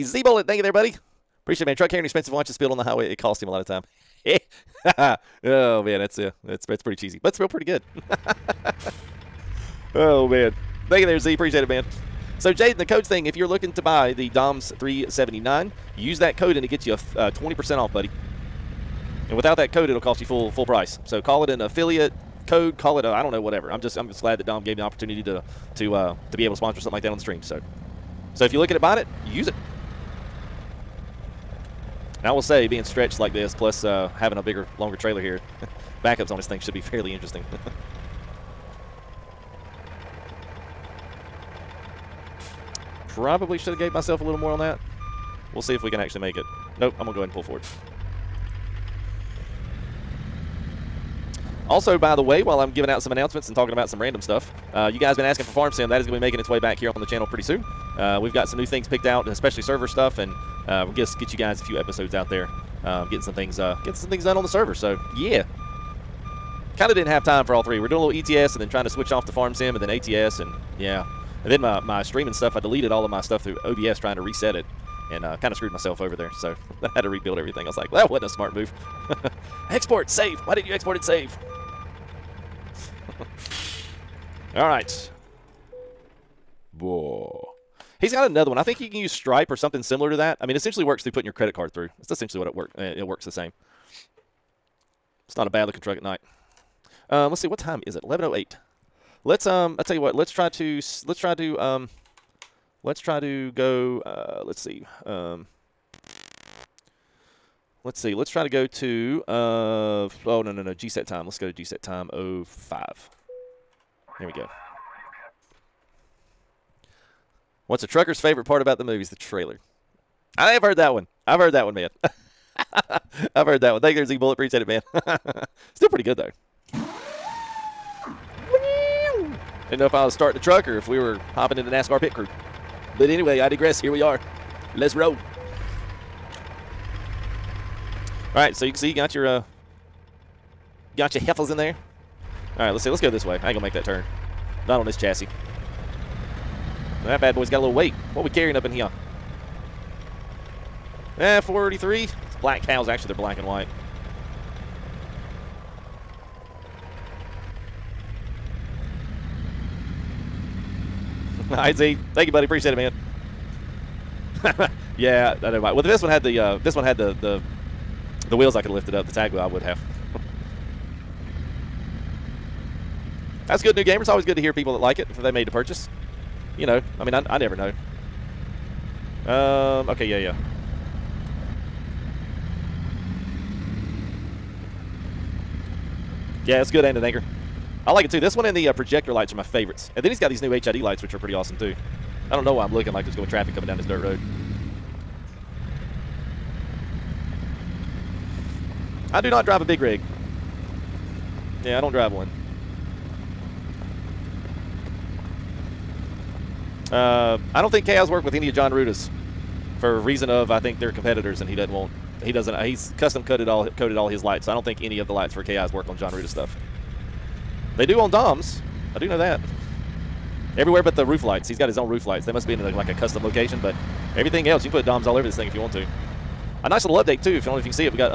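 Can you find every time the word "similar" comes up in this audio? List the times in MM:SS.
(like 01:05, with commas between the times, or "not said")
01:29.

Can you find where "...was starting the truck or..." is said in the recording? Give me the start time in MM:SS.
02:10.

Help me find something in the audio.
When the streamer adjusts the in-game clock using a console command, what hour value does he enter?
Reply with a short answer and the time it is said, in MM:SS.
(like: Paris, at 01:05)
05, at 01:52.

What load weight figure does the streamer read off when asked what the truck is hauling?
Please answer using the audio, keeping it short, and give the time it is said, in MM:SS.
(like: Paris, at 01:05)
43, at 02:31.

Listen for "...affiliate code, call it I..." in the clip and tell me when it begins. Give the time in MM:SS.
00:21.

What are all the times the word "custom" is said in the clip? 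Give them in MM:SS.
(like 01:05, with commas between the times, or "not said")
03:32, 03:42.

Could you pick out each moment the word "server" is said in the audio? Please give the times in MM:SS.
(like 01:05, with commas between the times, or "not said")
00:59, 01:04.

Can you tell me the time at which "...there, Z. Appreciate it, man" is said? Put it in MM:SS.
00:11.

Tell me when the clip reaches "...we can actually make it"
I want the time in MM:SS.
00:45.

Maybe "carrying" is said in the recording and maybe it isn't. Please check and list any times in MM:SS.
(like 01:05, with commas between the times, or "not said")
00:01, 02:28.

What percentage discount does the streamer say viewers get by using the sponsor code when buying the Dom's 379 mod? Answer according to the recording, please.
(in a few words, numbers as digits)
20%.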